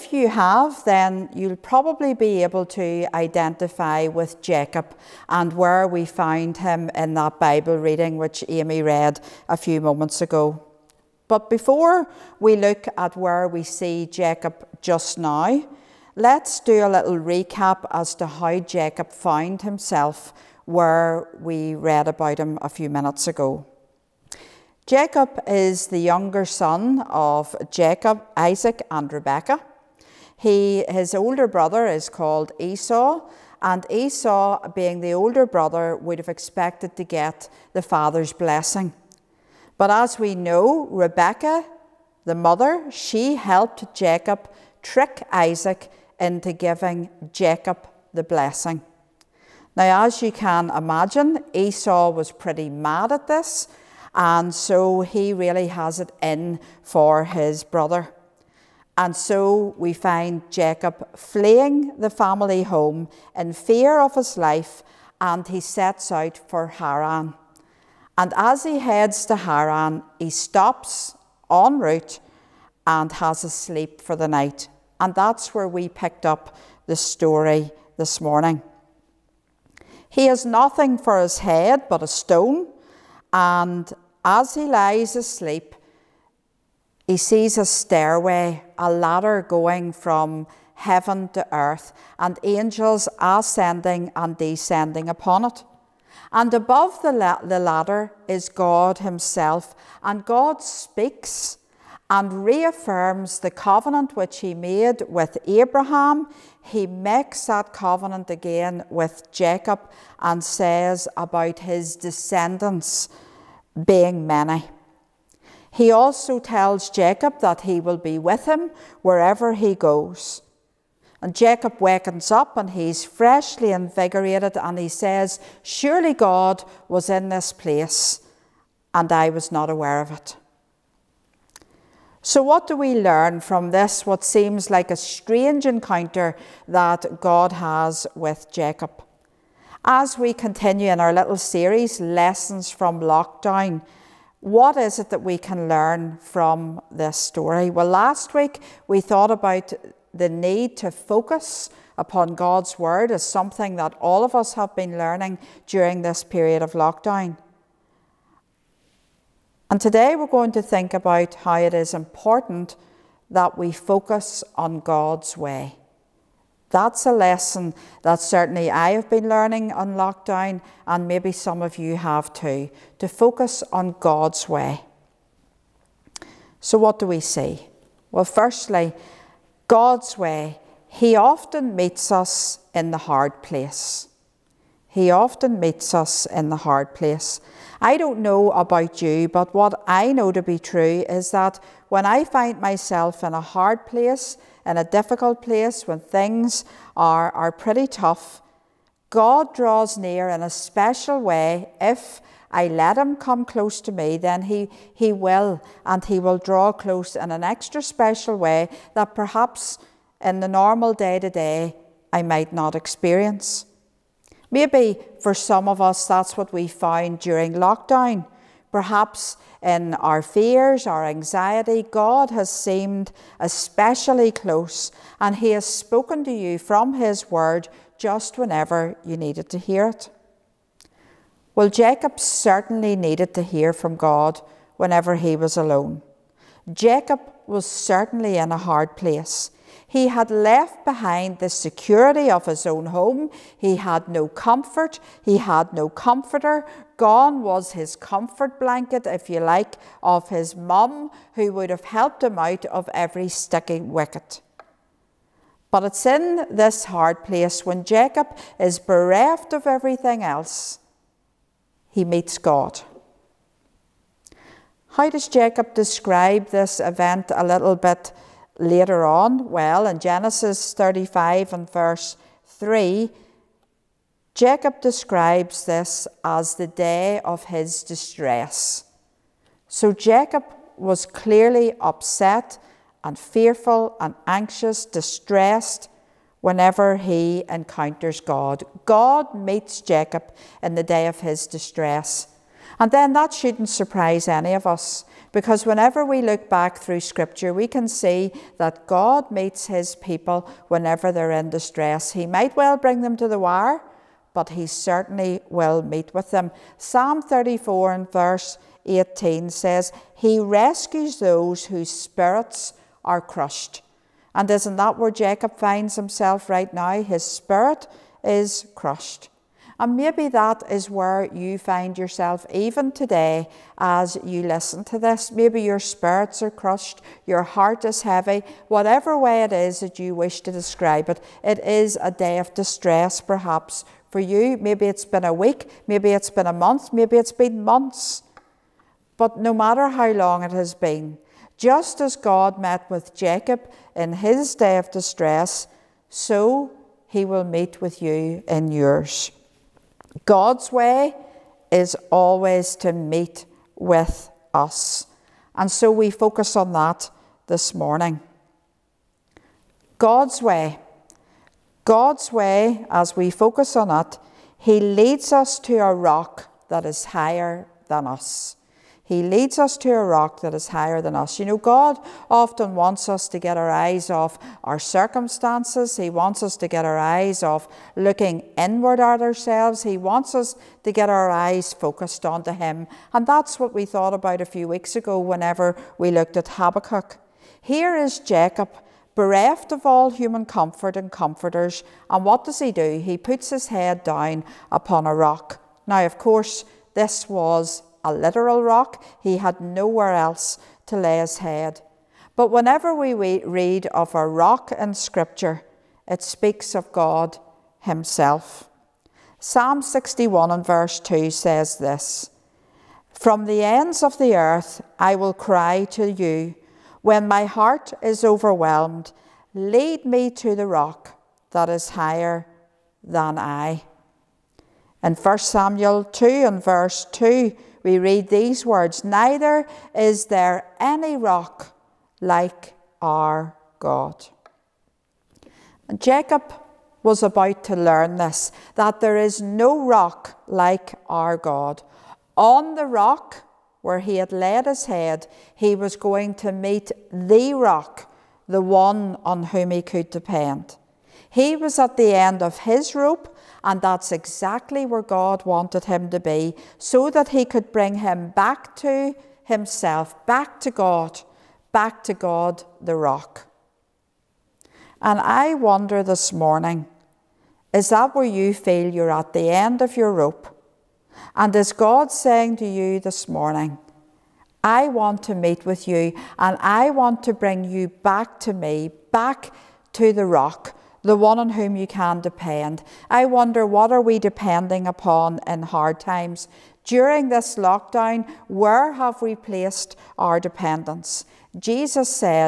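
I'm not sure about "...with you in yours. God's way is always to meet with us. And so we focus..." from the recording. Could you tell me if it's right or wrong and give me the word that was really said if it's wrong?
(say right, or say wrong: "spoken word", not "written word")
right.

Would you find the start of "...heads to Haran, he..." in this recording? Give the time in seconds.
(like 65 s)
68 s.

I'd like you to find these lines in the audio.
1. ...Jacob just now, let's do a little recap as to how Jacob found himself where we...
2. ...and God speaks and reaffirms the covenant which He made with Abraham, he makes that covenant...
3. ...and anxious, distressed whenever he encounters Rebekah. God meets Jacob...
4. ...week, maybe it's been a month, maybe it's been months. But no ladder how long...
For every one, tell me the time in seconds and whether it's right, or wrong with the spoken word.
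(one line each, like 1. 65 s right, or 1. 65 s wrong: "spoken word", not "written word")
1. 14 s right
2. 100 s right
3. 283 s wrong: "God", not "Rebekah"
4. 335 s wrong: "matter", not "ladder".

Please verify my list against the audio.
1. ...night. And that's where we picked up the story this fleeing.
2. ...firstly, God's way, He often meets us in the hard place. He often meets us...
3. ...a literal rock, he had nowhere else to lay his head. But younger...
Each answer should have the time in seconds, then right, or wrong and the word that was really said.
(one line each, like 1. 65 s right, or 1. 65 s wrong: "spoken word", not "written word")
1. 74 s wrong: "morning", not "fleeing"
2. 178 s right
3. 398 s wrong: "whenever", not "younger".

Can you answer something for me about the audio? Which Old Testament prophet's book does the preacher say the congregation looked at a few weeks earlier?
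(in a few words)
Habakkuk.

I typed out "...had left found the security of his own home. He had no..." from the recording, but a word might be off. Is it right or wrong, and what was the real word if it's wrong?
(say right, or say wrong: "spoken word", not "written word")
wrong: "behind", not "found".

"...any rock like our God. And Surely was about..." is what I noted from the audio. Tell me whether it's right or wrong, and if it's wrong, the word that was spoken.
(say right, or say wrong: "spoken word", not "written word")
wrong: "Jacob", not "Surely".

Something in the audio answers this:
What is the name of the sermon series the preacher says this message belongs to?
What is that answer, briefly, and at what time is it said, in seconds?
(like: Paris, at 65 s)
Lessons from Lockdown, at 141 s.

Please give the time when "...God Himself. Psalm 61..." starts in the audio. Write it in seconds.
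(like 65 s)
406 s.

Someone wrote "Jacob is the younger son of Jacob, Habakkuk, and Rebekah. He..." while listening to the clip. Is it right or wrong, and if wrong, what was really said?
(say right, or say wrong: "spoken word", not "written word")
wrong: "Isaac", not "Habakkuk".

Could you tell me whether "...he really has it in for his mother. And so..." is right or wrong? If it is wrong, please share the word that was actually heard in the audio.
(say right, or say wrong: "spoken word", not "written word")
wrong: "brother", not "mother".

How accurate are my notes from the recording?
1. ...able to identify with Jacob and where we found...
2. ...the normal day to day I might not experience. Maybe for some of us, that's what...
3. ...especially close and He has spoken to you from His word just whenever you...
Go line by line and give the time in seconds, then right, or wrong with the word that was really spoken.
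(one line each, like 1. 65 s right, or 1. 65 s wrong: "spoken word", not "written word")
1. 2 s right
2. 210 s right
3. 223 s right.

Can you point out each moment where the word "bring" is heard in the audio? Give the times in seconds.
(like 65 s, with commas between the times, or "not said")
302 s, 457 s, 477 s.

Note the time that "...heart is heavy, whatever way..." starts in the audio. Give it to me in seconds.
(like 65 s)
327 s.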